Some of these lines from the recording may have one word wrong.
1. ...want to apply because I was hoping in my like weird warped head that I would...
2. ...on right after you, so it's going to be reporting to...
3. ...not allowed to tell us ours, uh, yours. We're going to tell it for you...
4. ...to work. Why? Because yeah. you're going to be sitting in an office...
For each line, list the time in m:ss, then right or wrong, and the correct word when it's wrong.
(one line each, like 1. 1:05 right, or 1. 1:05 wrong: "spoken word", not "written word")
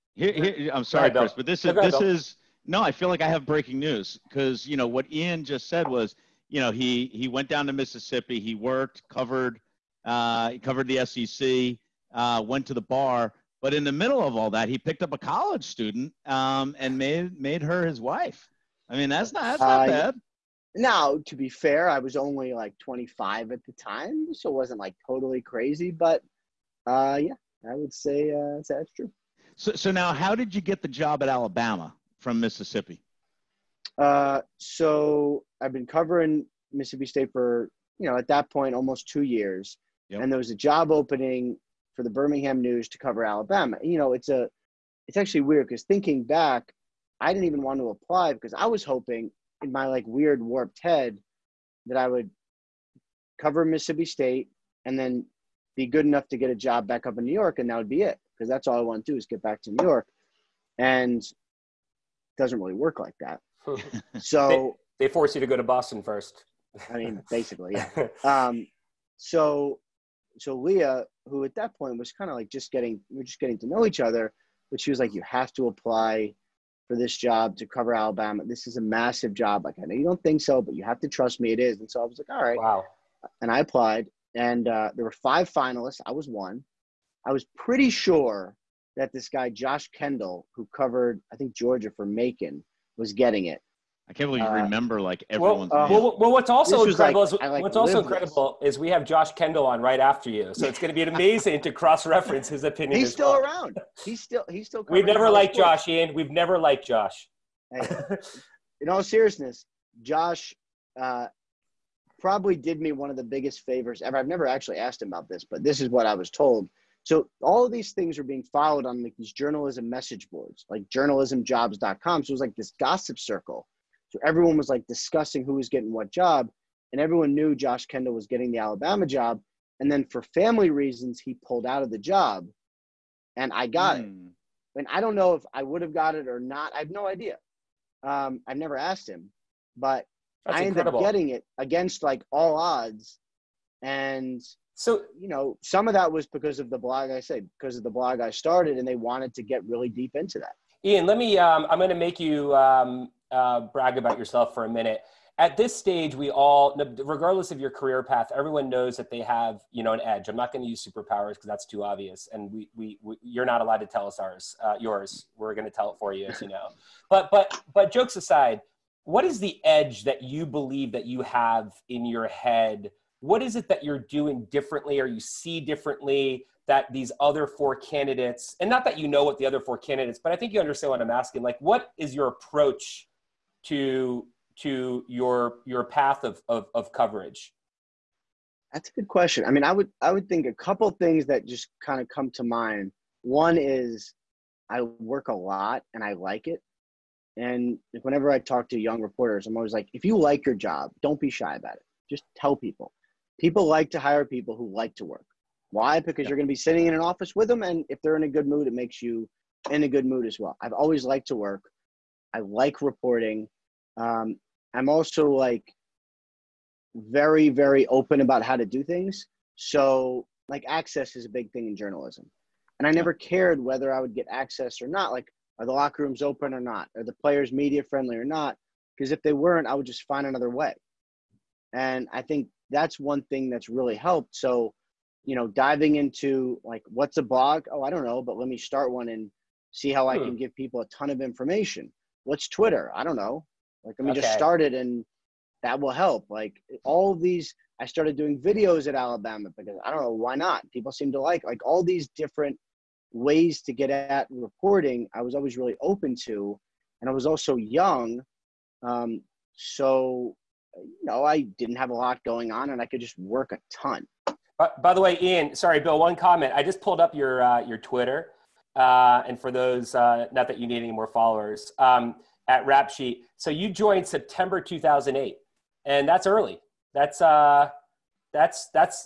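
1. 0:47 right
2. 1:39 wrong: "amazing", not "reporting"
3. 2:43 right
4. 3:24 right.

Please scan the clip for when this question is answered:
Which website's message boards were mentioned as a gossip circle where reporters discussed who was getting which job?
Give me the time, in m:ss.
2:00.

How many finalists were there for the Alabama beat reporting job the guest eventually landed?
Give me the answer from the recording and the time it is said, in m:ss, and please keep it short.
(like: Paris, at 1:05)
5, at 1:25.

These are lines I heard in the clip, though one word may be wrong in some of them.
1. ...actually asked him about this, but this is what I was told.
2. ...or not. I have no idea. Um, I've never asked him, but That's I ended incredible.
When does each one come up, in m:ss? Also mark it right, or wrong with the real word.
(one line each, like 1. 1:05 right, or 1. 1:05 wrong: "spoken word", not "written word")
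1. 1:54 right
2. 2:16 right.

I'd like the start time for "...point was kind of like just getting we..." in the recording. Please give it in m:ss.
1:11.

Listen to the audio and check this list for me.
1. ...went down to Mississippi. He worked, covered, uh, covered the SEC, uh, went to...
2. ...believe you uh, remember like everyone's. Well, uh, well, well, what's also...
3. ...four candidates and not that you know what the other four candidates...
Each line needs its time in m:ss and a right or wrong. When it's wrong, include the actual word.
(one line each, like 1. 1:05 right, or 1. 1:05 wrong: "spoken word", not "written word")
1. 0:07 right
2. 1:34 right
3. 2:57 right.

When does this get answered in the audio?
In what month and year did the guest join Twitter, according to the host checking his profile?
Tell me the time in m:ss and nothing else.
4:34.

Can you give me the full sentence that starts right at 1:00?
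And doesn't really work like that.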